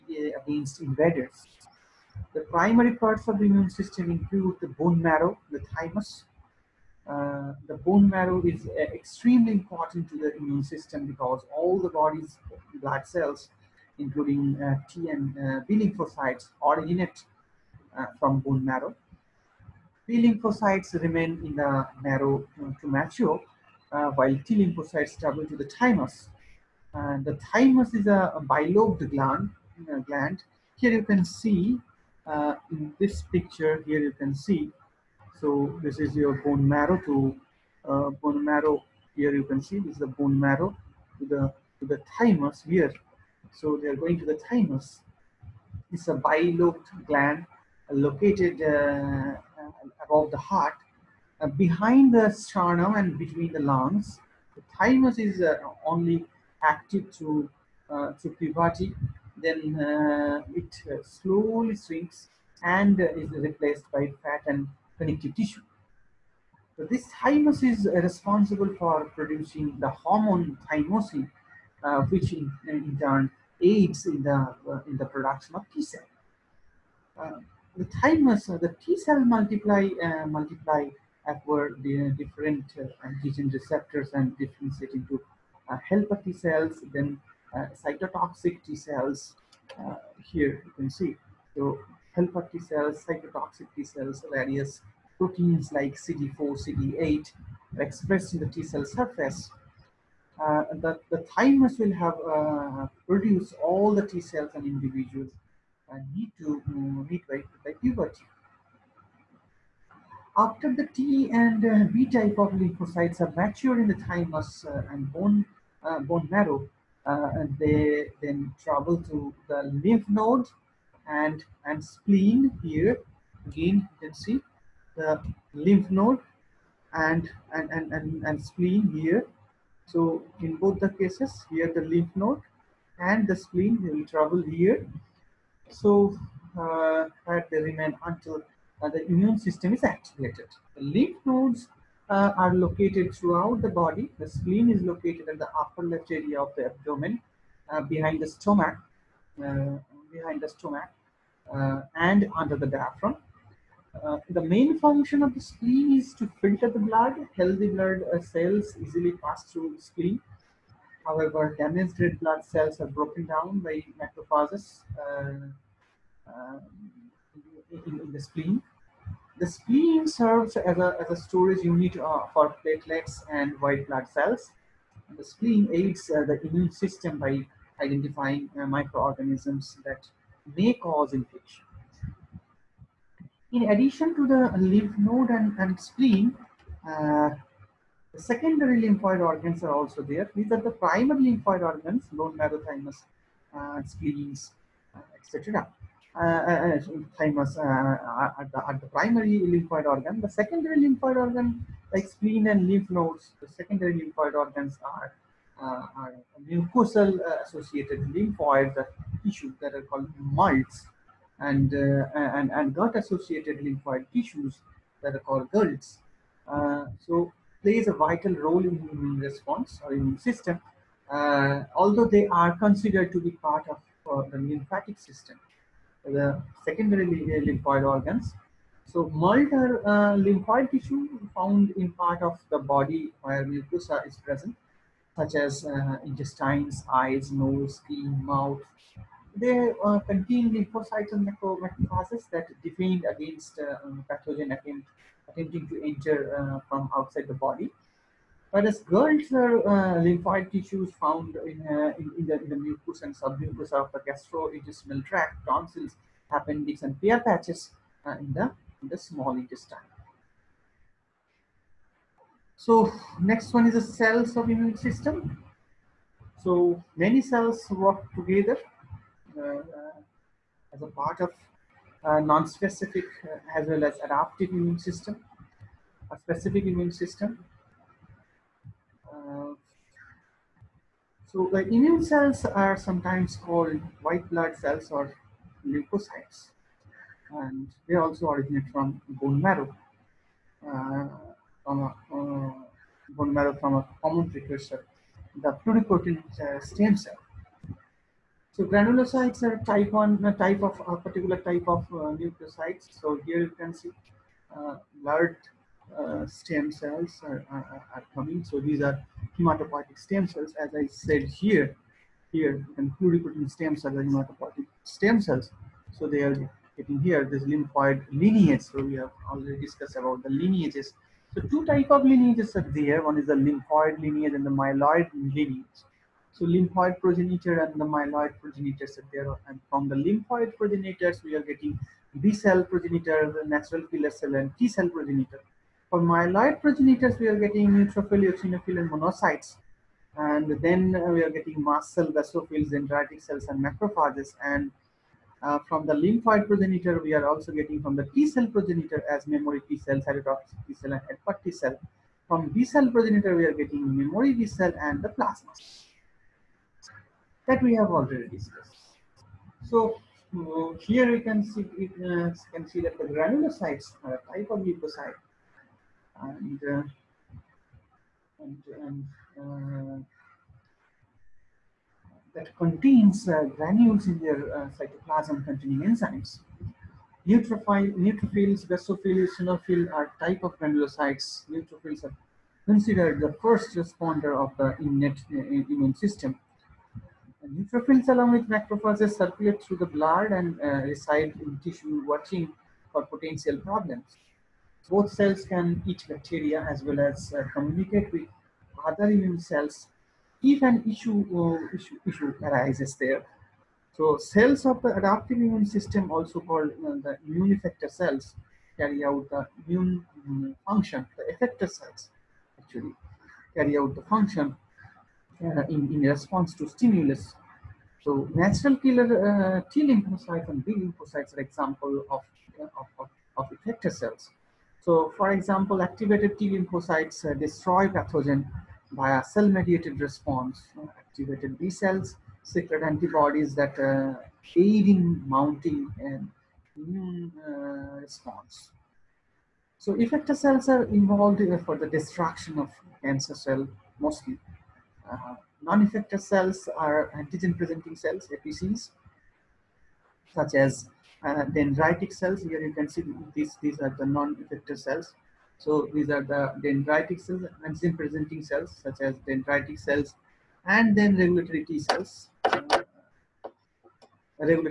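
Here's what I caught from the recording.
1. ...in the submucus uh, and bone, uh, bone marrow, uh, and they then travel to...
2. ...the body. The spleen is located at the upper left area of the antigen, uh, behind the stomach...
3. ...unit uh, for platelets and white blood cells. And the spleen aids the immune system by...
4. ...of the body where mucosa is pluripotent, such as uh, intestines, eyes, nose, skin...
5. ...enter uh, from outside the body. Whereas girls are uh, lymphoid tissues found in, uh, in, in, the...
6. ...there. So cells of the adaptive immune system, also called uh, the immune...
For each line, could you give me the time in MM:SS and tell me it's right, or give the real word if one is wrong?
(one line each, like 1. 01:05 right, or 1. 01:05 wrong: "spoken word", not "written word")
1. 01:53 wrong: "thymus", not "submucus"
2. 02:23 wrong: "abdomen", not "antigen"
3. 02:51 right
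4. 03:52 wrong: "present", not "pluripotent"
5. 04:05 right
6. 06:42 right.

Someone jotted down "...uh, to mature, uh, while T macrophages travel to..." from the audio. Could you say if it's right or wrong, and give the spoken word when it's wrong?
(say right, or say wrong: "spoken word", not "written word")
wrong: "lymphocytes", not "macrophages".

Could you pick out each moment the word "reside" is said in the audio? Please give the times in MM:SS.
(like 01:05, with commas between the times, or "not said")
06:30.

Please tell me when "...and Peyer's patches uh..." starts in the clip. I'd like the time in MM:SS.
04:16.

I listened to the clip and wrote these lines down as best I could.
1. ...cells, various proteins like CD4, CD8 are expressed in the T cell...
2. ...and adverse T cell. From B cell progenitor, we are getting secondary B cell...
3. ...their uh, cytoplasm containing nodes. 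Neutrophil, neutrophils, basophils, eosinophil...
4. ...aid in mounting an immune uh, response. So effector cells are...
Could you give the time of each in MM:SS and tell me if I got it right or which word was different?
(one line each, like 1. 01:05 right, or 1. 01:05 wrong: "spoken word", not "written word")
1. 01:33 right
2. 05:50 wrong: "memory", not "secondary"
3. 06:14 wrong: "enzymes", not "nodes"
4. 07:14 right.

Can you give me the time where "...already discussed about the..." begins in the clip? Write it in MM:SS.
05:19.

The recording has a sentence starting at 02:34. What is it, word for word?
Uh, the main function of the spleen is to filter the blood.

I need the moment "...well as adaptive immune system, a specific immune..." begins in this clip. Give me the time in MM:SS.
04:33.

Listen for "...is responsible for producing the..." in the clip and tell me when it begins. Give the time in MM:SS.
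01:07.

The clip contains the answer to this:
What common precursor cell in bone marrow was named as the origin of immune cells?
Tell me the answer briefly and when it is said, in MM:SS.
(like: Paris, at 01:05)
pluripotent stem cell, at 04:55.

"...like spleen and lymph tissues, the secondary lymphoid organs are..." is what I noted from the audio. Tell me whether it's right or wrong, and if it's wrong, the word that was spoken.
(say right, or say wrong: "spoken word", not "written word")
wrong: "nodes", not "tissues".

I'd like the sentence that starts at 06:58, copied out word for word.
So natural killer uh, T lymphocytes and B lymphocytes are example of, uh, of, of, of effector cells.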